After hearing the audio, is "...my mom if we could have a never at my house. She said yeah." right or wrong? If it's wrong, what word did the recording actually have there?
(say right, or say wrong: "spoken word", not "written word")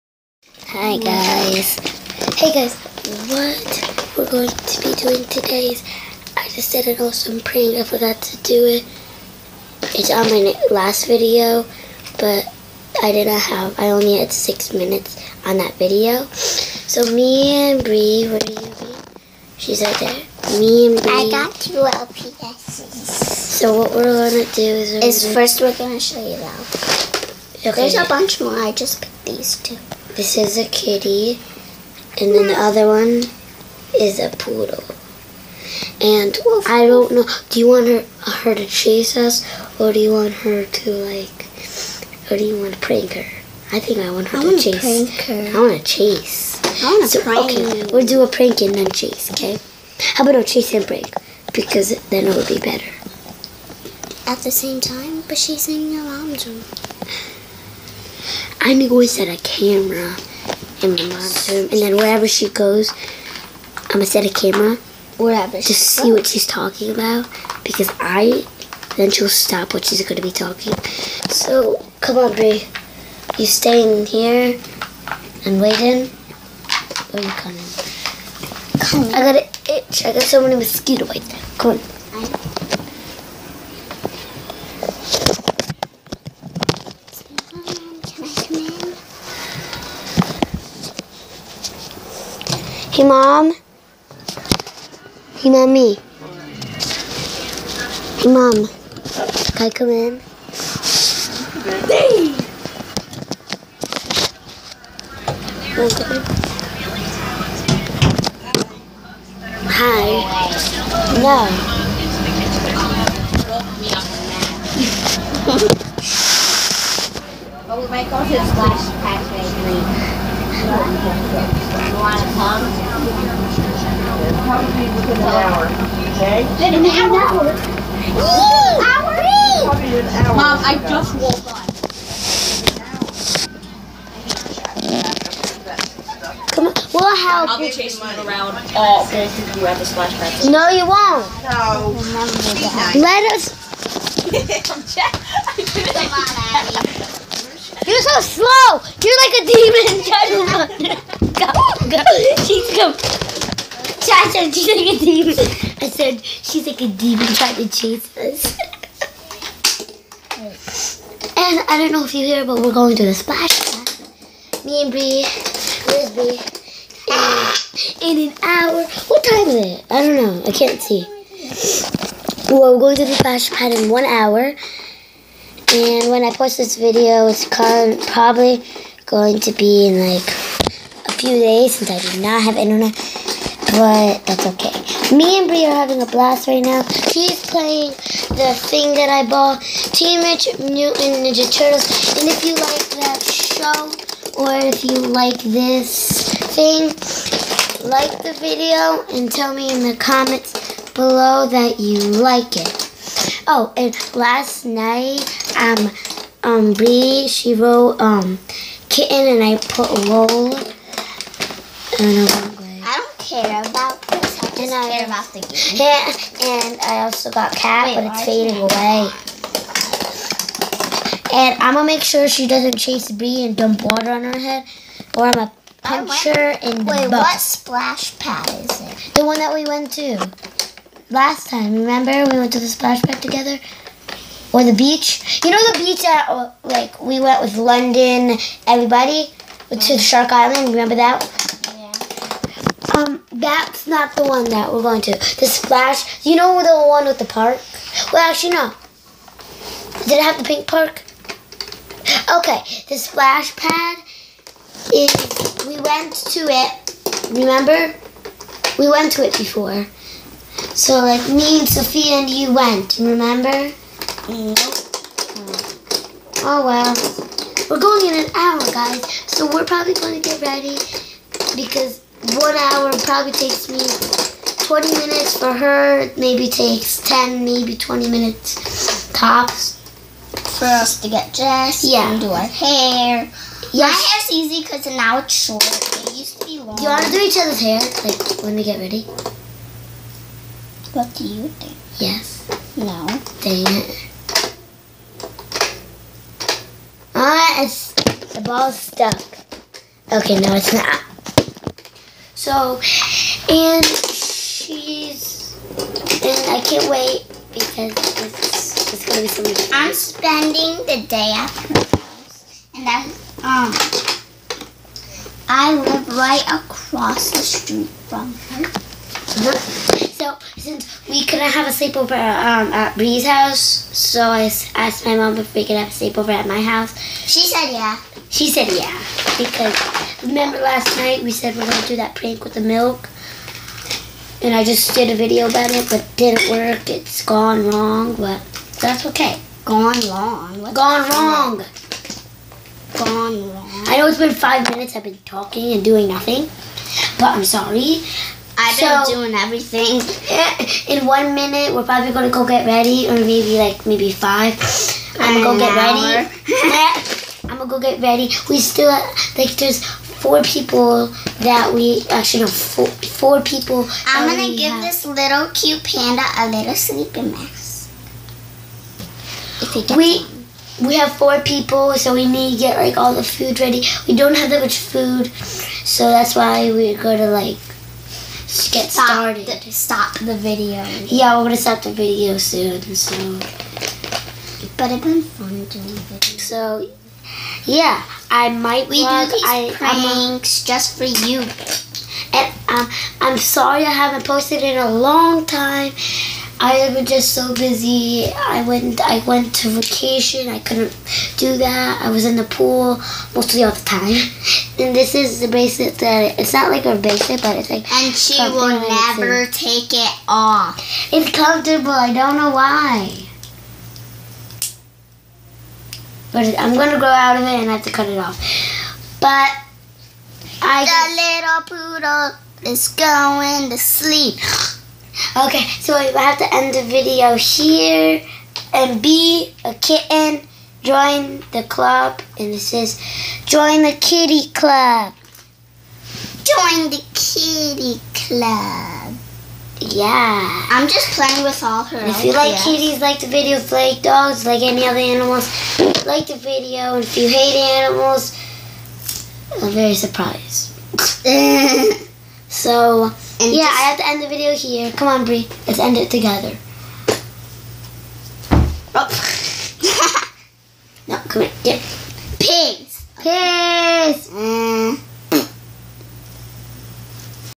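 wrong: "sleepover", not "never".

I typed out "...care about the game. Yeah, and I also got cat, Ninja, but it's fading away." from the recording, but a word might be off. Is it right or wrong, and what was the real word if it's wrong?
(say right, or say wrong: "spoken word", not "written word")
wrong: "Wait", not "Ninja".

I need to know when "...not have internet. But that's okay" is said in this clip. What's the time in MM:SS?
03:02.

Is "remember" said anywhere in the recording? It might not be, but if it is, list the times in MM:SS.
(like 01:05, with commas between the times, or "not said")
03:51, 04:00, 04:17, 04:22, 05:30.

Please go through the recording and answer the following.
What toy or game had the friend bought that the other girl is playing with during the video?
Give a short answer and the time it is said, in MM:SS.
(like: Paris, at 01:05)
Teenage Mutant Ninja Turtles, at 03:09.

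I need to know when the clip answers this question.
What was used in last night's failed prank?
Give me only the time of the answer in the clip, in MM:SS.
05:32.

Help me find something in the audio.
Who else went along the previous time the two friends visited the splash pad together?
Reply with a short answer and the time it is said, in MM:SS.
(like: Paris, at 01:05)
Sophia, at 04:21.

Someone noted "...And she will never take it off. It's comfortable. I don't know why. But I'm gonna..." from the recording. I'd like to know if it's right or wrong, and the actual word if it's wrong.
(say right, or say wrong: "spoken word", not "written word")
right.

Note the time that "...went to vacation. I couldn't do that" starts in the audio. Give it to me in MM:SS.
06:39.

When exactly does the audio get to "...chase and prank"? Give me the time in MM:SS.
00:50.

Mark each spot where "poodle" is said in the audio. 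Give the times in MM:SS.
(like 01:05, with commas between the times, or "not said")
00:34, 07:01.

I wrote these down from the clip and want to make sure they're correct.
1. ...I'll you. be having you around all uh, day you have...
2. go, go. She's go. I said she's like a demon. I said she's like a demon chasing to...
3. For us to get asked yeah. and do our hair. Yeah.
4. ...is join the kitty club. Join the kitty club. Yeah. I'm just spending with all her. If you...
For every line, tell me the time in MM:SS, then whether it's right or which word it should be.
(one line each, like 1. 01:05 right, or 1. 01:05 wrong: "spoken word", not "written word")
1. 02:17 wrong: "chasing", not "having"
2. 02:31 wrong: "trying", not "chasing"
3. 04:40 wrong: "dressed", not "asked"
4. 07:12 wrong: "playing", not "spending".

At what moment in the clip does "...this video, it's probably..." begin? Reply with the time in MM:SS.
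02:56.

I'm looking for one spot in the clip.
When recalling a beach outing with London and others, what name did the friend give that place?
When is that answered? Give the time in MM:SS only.
03:59.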